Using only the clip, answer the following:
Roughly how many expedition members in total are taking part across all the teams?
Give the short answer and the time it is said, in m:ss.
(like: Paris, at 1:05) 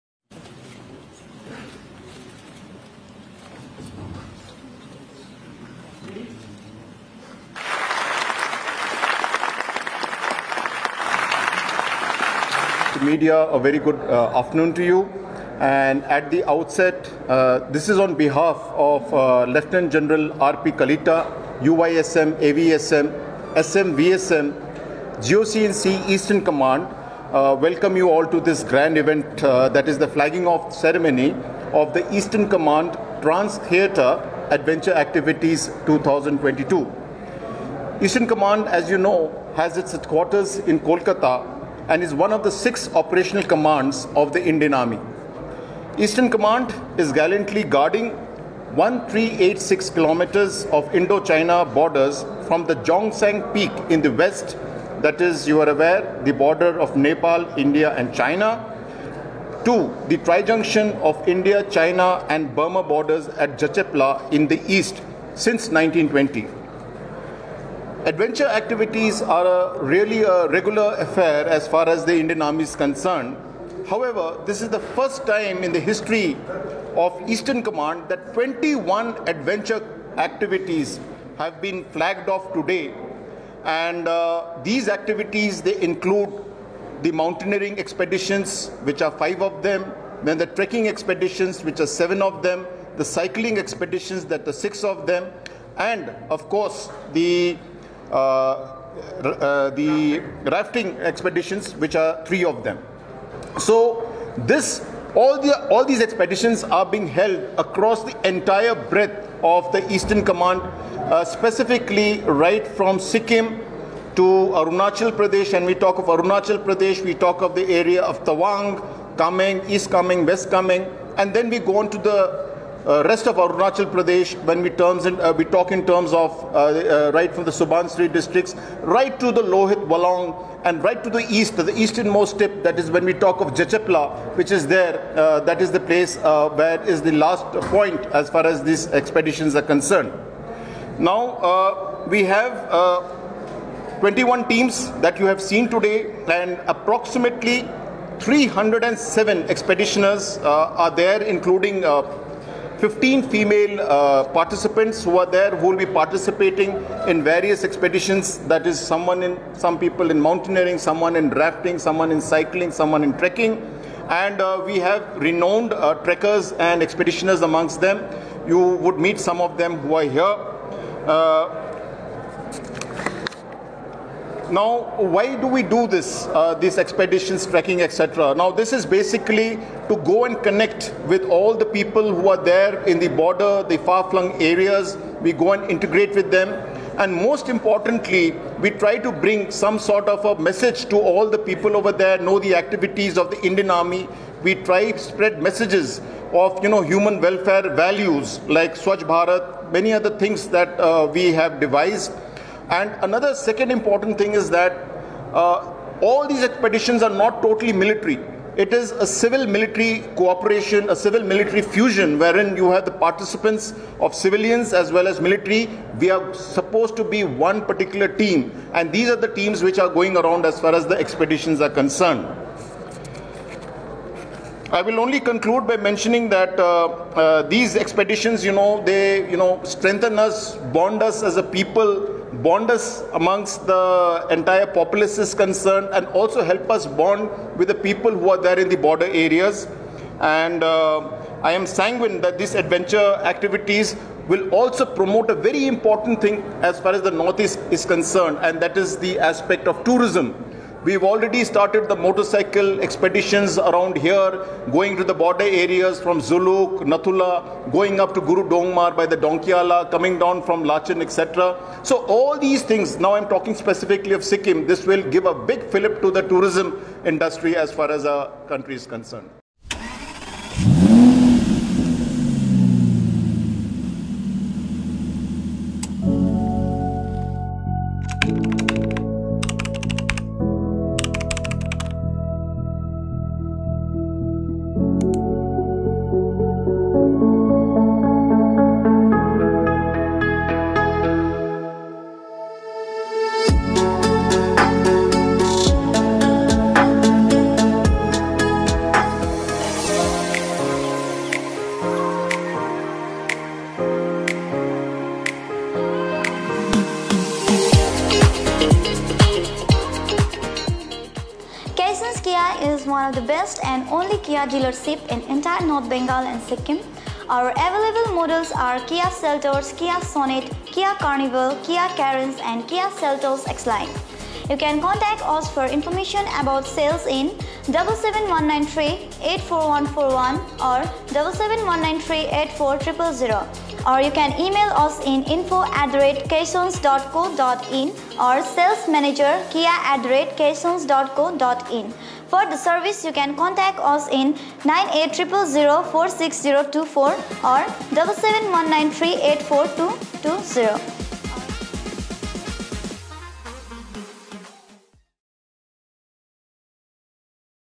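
307, at 2:28.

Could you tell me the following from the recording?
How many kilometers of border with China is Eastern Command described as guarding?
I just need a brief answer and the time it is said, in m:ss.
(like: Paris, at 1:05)
1386, at 0:48.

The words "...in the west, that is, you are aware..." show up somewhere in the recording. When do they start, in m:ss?
0:53.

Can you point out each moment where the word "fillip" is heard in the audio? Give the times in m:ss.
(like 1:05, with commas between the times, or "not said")
4:25.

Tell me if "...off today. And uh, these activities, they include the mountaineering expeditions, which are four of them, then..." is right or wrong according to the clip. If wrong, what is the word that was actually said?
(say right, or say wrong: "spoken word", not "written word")
wrong: "five", not "four".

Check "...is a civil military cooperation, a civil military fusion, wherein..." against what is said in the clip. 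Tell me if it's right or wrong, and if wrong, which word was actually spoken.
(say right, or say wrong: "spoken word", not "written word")
right.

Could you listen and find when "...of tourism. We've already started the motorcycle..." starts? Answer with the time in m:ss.
4:09.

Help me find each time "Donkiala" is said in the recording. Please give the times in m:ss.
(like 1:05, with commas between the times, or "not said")
4:19.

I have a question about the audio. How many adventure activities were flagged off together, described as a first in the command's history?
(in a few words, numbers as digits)
21.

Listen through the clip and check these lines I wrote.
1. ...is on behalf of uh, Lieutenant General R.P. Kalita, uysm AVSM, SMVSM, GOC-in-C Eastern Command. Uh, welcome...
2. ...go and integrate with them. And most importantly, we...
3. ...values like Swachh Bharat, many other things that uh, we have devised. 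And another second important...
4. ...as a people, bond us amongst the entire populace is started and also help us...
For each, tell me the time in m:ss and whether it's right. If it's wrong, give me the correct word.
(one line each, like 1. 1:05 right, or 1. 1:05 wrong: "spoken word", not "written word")
1. 0:17 right
2. 3:05 right
3. 3:17 right
4. 3:51 wrong: "concerned", not "started".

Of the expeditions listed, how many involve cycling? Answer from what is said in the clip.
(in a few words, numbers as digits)
6.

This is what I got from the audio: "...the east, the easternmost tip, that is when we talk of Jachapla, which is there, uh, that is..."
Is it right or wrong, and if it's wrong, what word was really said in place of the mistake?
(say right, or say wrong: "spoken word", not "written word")
right.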